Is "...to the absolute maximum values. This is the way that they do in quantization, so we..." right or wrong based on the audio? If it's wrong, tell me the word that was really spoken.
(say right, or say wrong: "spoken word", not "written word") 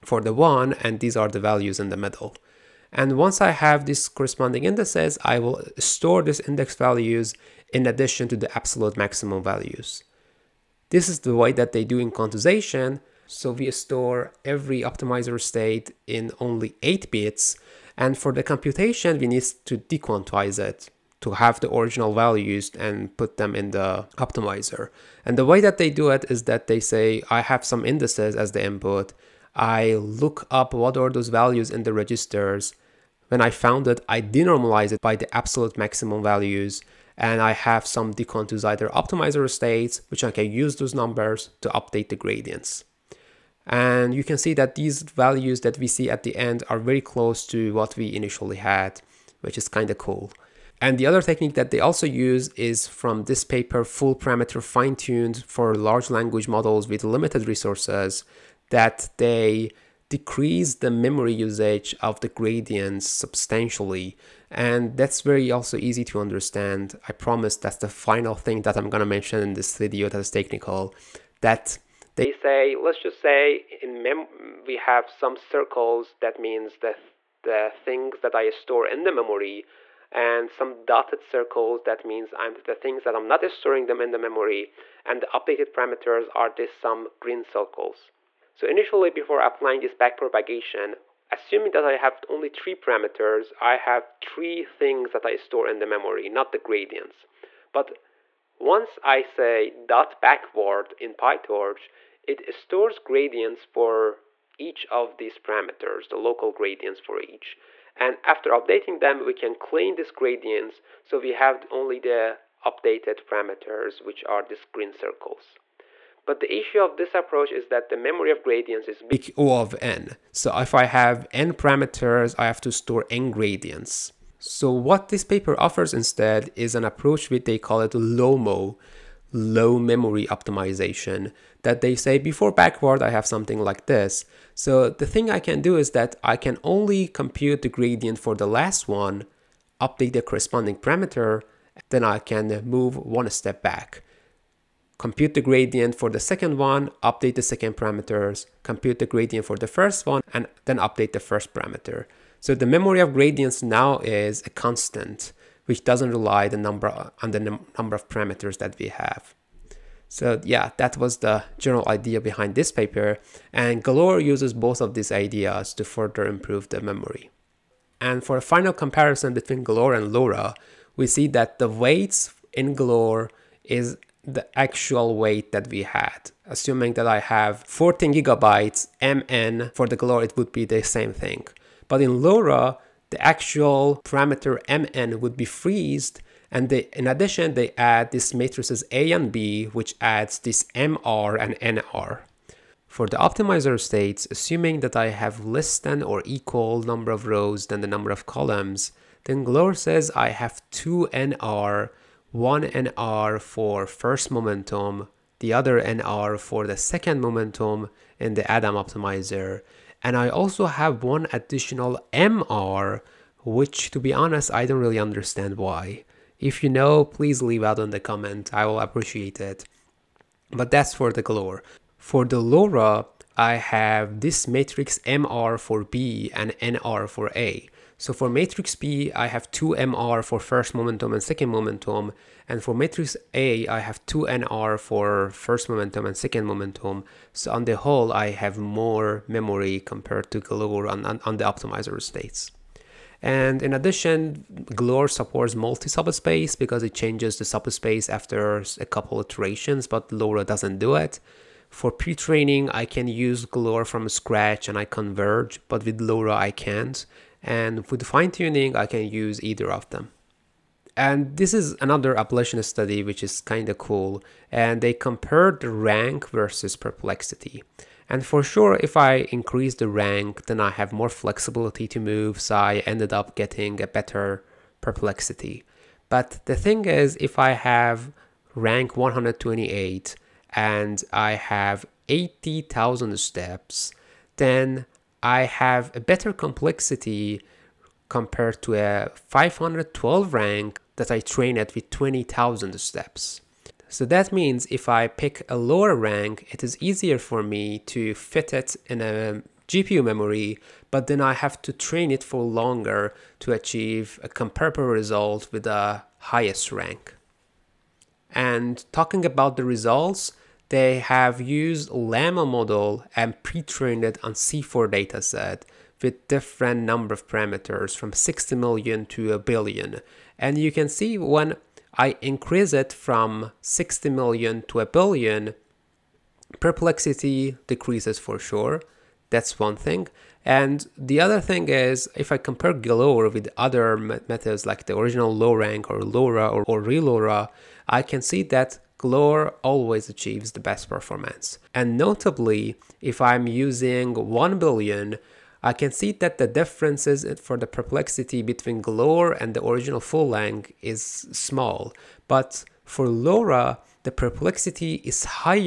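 right.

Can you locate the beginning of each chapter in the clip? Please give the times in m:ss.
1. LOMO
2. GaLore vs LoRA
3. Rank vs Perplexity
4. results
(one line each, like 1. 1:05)
1. 0:50
2. 2:48
3. 4:20
4. 5:07.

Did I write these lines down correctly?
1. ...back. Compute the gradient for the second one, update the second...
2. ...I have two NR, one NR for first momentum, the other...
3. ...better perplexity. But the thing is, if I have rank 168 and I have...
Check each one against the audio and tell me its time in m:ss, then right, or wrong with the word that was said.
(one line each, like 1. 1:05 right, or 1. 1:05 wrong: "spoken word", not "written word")
1. 2:23 right
2. 3:20 right
3. 4:33 wrong: "128", not "168".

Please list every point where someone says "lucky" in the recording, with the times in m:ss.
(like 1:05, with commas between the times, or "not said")
not said.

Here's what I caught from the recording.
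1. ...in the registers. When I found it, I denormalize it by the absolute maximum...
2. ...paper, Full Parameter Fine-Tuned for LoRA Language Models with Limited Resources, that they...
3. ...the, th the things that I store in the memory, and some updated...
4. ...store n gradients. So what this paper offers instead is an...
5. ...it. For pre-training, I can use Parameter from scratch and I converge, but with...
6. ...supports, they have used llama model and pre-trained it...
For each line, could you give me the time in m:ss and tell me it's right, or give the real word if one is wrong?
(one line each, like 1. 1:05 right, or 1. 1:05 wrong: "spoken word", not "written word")
1. 0:31 right
2. 0:53 wrong: "Large", not "LoRA"
3. 1:16 wrong: "dotted", not "updated"
4. 2:02 right
5. 4:10 wrong: "GaLore", not "Parameter"
6. 5:09 wrong: "results", not "supports".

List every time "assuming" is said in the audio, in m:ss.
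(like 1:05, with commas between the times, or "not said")
1:31, 2:56, 3:14.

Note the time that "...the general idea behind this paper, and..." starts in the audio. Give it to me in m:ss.
2:41.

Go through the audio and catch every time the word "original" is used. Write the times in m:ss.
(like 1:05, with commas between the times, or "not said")
0:21, 5:34, 5:49.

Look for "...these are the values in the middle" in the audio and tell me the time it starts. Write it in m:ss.
0:01.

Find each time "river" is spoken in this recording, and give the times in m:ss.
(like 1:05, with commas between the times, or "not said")
not said.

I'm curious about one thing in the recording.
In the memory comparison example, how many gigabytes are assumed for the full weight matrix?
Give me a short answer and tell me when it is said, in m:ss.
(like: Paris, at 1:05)
14 gigabytes, at 2:57.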